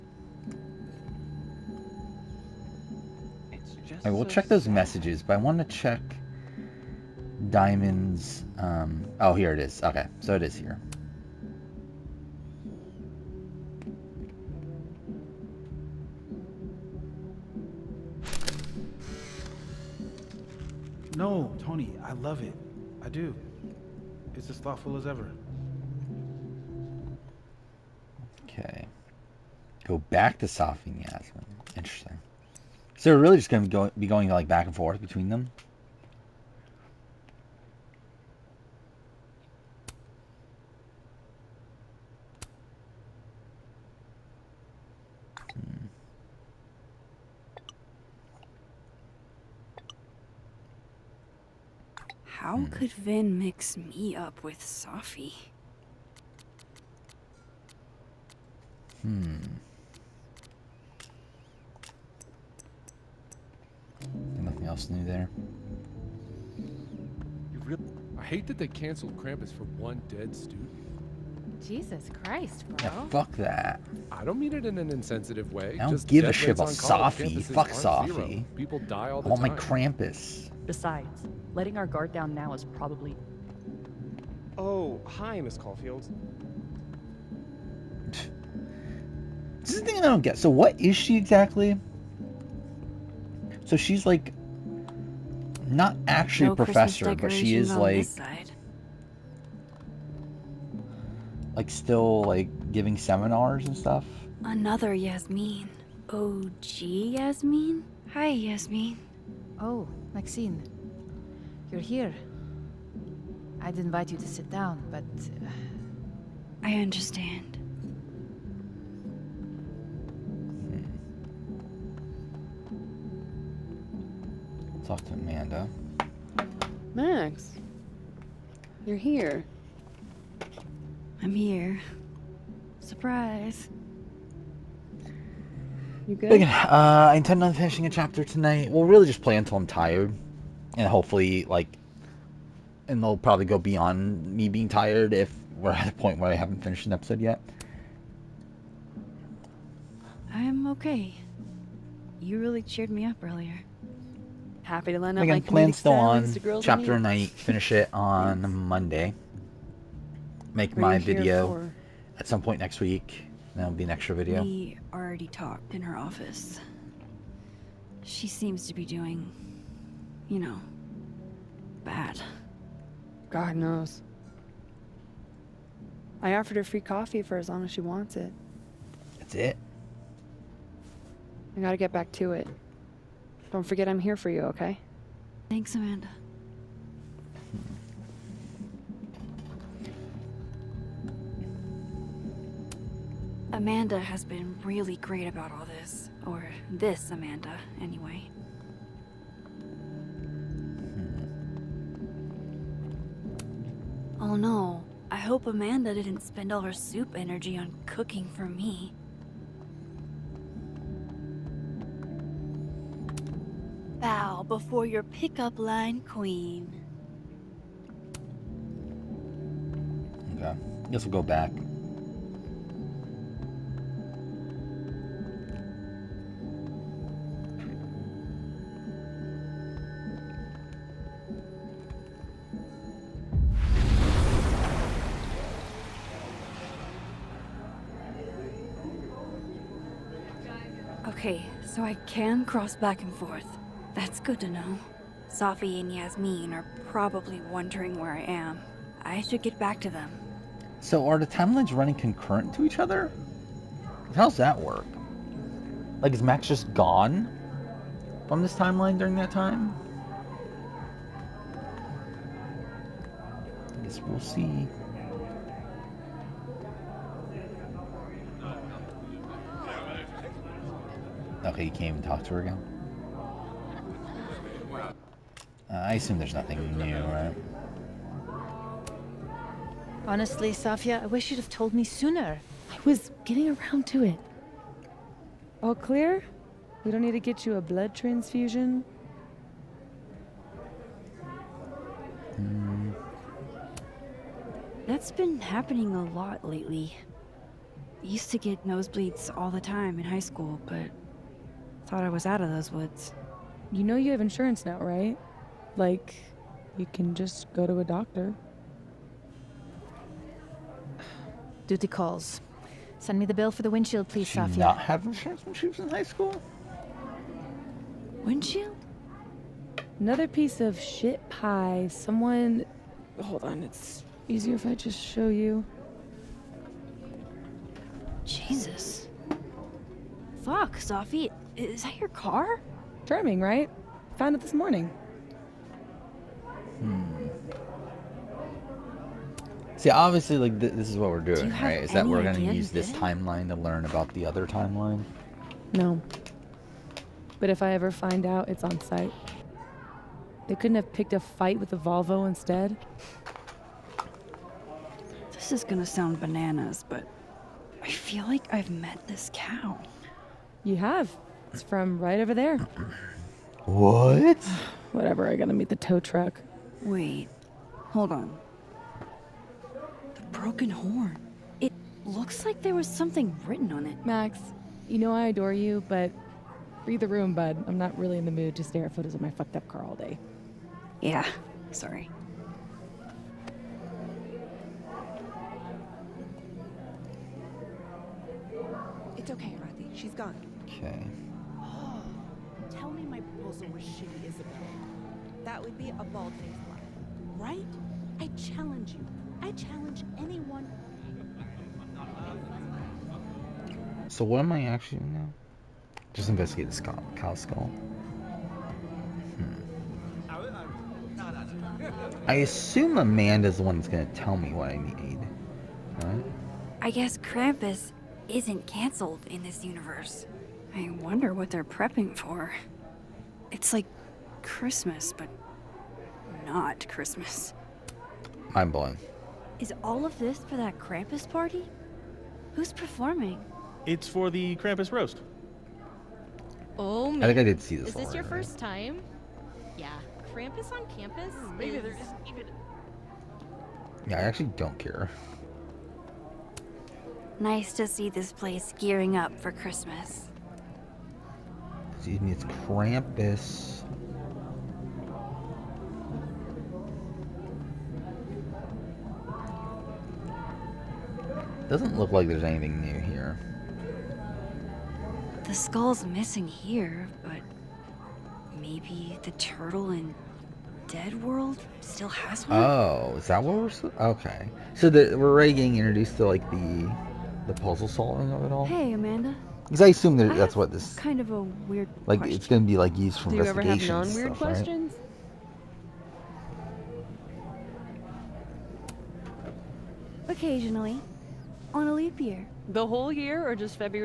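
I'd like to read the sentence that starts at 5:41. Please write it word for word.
Is that we're gonna use this timeline to learn about the other timeline?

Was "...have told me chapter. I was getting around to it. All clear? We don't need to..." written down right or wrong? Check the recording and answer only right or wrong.
wrong.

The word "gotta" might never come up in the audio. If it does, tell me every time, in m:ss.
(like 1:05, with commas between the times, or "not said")
3:01, 6:05.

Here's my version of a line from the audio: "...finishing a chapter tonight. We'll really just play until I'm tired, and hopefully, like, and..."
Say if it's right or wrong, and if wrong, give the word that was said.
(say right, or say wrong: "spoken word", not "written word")
right.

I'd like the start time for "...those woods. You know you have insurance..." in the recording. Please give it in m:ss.
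5:02.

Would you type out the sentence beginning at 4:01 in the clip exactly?
Okay, so I can cross back and forth.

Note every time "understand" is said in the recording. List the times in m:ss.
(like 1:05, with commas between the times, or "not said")
1:56.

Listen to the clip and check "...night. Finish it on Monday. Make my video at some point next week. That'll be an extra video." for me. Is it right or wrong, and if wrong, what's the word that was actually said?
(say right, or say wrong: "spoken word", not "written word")
right.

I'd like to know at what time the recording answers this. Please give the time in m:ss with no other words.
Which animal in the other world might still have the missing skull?
7:49.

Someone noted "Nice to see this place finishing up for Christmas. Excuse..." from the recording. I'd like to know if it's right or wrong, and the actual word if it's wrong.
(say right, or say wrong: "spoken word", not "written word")
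wrong: "gearing", not "finishing".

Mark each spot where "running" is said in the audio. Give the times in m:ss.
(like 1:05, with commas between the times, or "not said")
4:11.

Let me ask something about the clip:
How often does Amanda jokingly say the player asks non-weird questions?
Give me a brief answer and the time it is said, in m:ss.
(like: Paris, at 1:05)
On a leap year, at 8:11.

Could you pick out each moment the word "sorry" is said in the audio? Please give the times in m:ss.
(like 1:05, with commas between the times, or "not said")
6:21.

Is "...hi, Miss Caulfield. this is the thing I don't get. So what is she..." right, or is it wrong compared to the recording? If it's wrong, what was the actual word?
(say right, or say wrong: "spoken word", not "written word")
right.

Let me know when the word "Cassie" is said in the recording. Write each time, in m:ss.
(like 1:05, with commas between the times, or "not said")
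not said.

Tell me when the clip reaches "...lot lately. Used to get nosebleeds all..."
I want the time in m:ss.
4:56.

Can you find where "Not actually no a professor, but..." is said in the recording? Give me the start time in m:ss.
1:35.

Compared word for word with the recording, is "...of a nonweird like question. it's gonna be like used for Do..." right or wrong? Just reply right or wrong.
wrong.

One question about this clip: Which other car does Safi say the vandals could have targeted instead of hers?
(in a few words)
The Volvo.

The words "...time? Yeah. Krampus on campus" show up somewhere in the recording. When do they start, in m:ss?
7:18.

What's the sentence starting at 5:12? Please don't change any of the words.
Send me the bill for the windshield, please, Safia.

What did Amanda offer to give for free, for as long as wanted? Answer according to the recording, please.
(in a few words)
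Coffee.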